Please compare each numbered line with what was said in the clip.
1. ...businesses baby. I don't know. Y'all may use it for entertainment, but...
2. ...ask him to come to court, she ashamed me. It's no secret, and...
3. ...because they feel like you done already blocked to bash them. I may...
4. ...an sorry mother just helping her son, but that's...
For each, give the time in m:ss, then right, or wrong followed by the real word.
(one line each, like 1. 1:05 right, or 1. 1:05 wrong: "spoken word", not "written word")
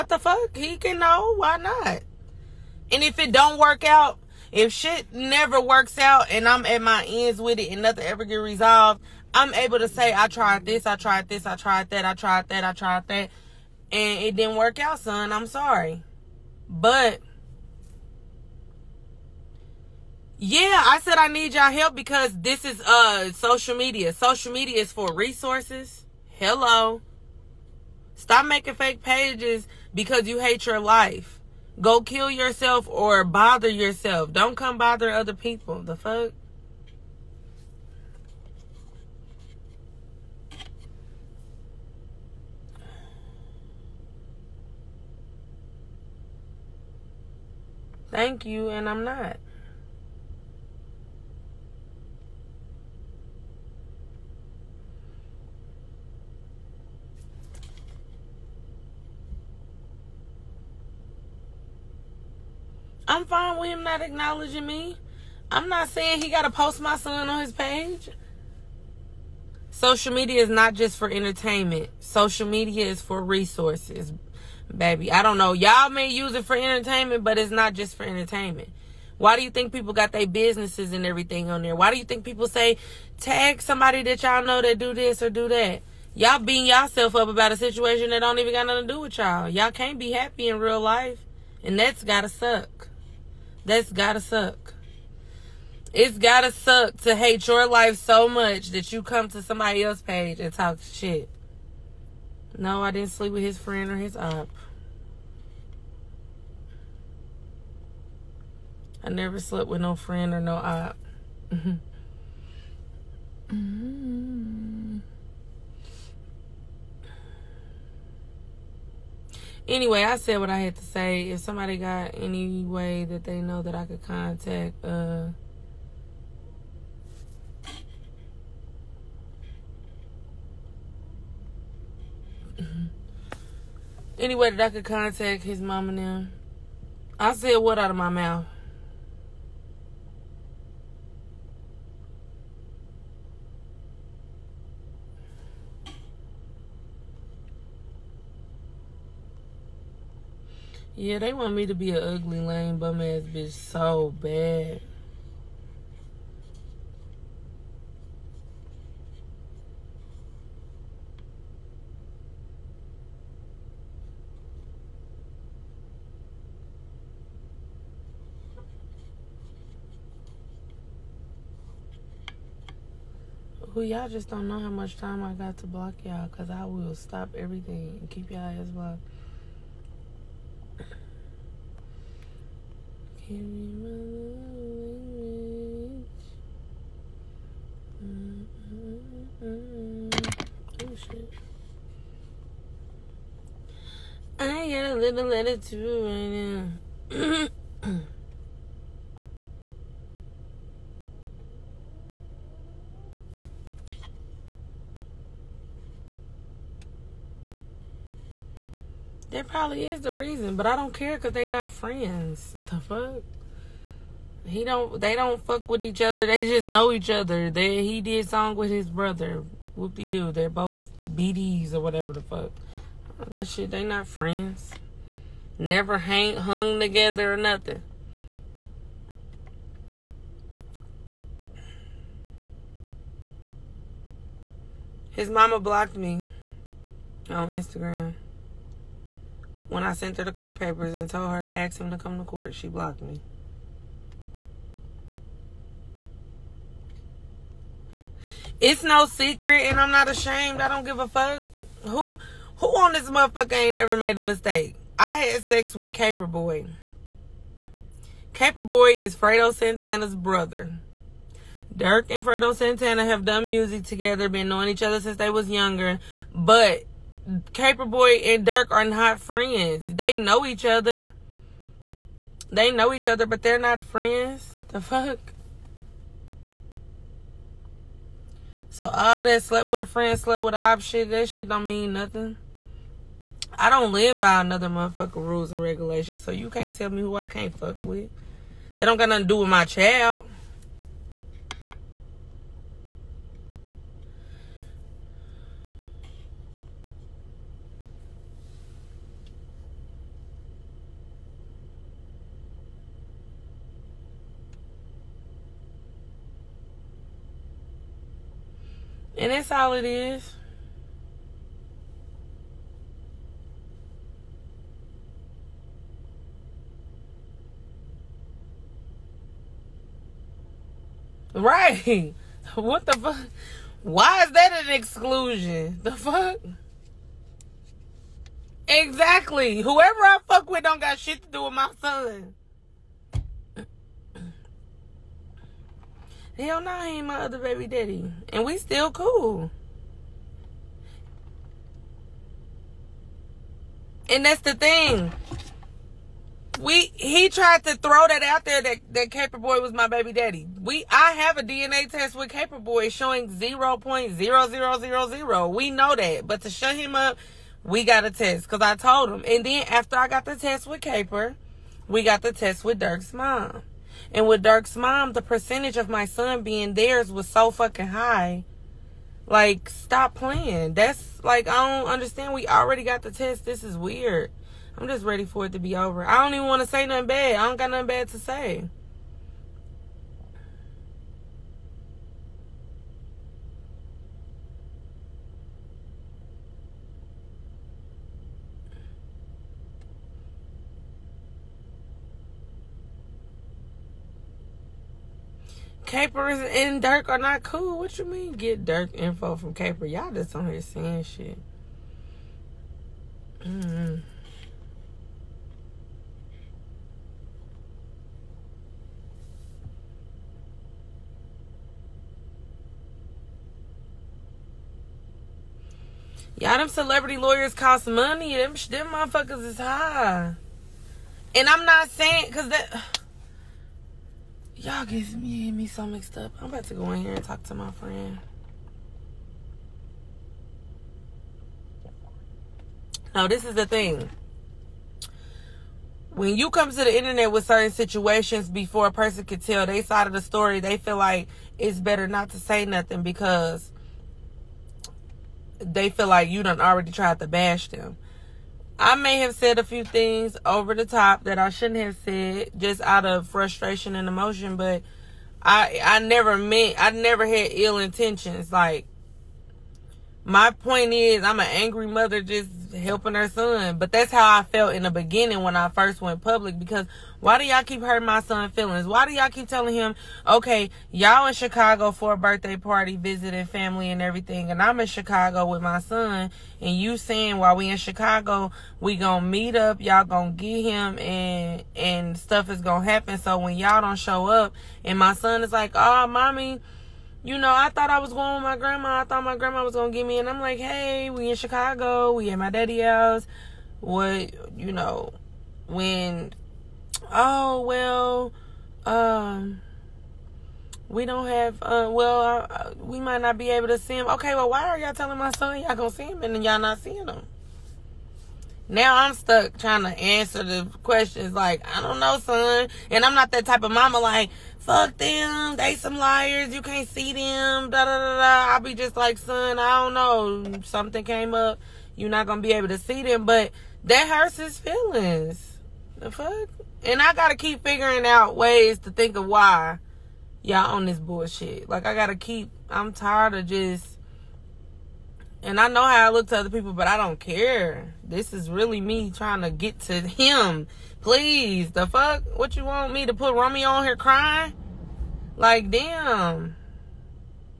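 1. 1:13 wrong: "resources", not "businesses"
2. 4:01 wrong: "blocked", not "ashamed"
3. 7:23 wrong: "tried", not "blocked"
4. 7:41 wrong: "angry", not "sorry".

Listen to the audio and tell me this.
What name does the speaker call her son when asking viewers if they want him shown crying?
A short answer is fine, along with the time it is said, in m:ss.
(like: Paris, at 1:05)
Romy, at 9:03.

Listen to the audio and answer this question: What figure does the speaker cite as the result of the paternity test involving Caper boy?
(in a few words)
0.0000.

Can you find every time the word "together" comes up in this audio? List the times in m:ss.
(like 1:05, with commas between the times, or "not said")
3:46, 4:23.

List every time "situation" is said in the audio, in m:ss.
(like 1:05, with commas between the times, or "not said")
1:27, 7:17.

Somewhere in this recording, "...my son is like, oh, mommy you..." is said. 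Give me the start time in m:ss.
8:04.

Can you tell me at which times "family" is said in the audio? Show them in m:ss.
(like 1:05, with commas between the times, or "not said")
7:53.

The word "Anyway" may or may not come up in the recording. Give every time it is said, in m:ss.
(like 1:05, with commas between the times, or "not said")
1:59, 2:14.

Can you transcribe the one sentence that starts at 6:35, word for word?
Capers and Durk are not cool.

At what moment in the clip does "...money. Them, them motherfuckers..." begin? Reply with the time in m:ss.
6:57.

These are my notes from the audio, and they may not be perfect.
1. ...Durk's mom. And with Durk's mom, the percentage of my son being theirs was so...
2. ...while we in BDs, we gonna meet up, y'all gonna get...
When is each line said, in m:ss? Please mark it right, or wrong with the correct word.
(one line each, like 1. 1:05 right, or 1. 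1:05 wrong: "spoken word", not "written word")
1. 6:02 right
2. 7:57 wrong: "Chicago", not "BDs".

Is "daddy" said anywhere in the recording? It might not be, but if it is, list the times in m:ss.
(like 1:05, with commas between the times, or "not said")
5:37, 5:50, 8:12.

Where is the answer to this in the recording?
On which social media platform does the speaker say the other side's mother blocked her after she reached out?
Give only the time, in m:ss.
3:57.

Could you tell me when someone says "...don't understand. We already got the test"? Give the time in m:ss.
6:11.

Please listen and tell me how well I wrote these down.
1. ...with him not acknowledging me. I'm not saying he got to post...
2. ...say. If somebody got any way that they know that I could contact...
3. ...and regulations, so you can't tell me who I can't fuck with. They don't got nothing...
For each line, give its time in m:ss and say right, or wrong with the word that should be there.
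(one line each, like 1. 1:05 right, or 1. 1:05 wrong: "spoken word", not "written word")
1. 1:03 right
2. 2:00 right
3. 4:45 right.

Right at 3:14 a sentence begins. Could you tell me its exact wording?
I got a little letter too right now.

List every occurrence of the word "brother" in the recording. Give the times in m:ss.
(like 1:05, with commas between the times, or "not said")
3:38, 4:20.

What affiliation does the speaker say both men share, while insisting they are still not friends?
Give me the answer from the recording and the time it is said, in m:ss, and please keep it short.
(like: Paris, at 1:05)
BDs, at 3:41.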